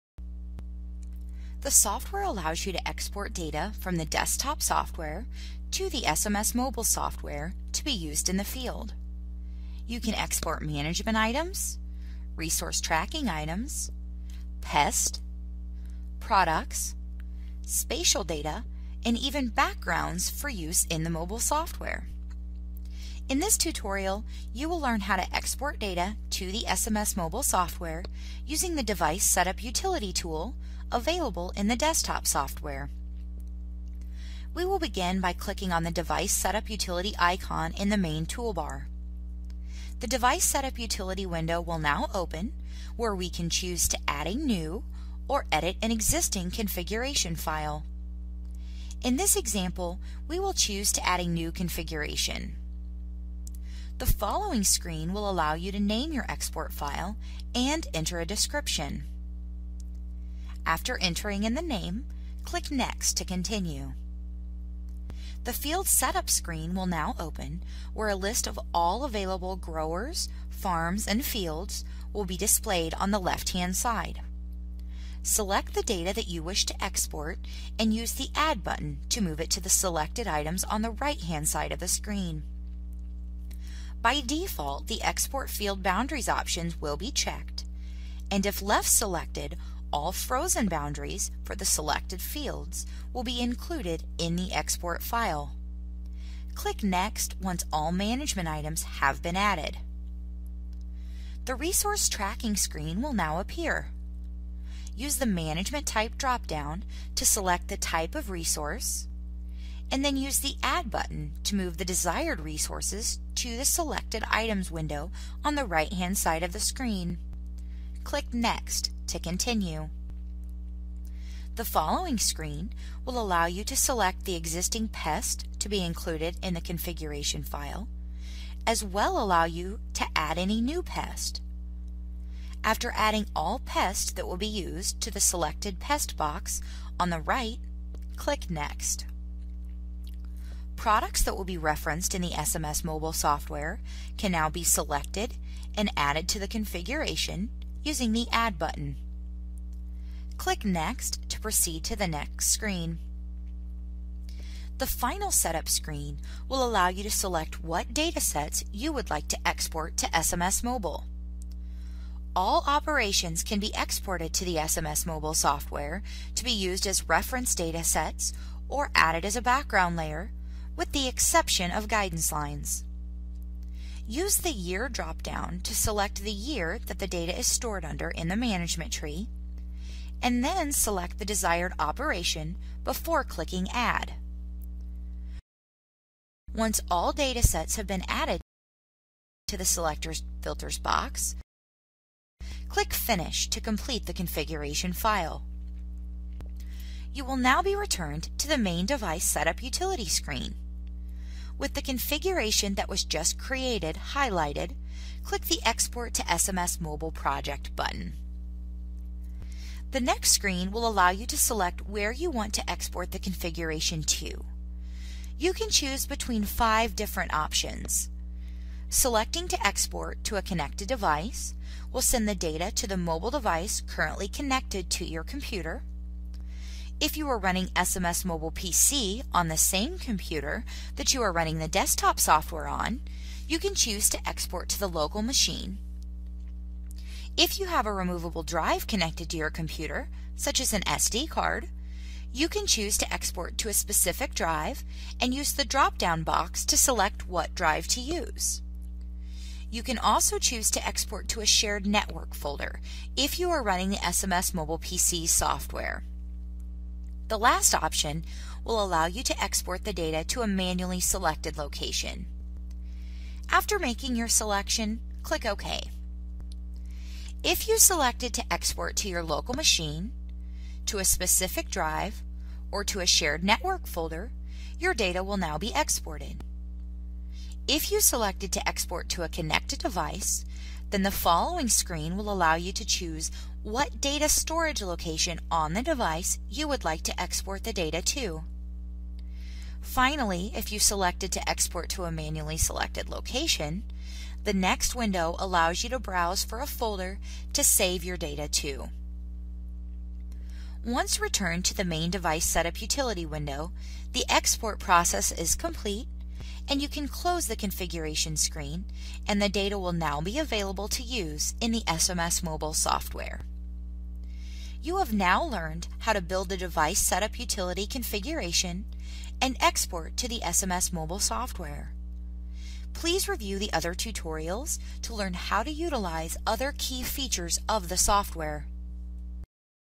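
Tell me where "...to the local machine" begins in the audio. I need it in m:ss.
3:54.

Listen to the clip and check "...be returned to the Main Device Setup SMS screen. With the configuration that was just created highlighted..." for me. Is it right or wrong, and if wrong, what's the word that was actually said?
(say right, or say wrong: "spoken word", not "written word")
wrong: "Utility", not "SMS".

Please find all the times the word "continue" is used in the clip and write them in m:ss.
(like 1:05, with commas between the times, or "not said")
1:03, 1:59.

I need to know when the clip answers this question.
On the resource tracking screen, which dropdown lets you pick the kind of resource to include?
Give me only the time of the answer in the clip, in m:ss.
1:45.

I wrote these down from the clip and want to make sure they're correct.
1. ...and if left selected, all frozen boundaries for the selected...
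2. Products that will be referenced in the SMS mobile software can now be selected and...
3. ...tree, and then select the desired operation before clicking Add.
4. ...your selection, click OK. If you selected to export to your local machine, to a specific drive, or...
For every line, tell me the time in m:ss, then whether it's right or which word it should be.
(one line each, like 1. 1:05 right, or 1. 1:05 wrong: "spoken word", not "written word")
1. 1:28 right
2. 2:20 right
3. 2:58 right
4. 4:24 right.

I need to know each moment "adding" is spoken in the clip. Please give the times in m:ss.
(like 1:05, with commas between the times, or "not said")
2:12.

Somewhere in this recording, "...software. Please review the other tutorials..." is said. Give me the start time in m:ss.
5:21.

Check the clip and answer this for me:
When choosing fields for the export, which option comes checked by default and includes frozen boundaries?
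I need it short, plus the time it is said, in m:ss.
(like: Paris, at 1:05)
Export Field Boundaries, at 1:25.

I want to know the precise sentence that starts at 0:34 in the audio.
We will begin by clicking on the Device Setup Utility icon in the main toolbar.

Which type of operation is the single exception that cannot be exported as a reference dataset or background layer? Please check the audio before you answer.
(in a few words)
guidance lines.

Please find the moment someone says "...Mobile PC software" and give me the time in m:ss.
4:14.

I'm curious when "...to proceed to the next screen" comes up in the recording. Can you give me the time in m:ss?
2:31.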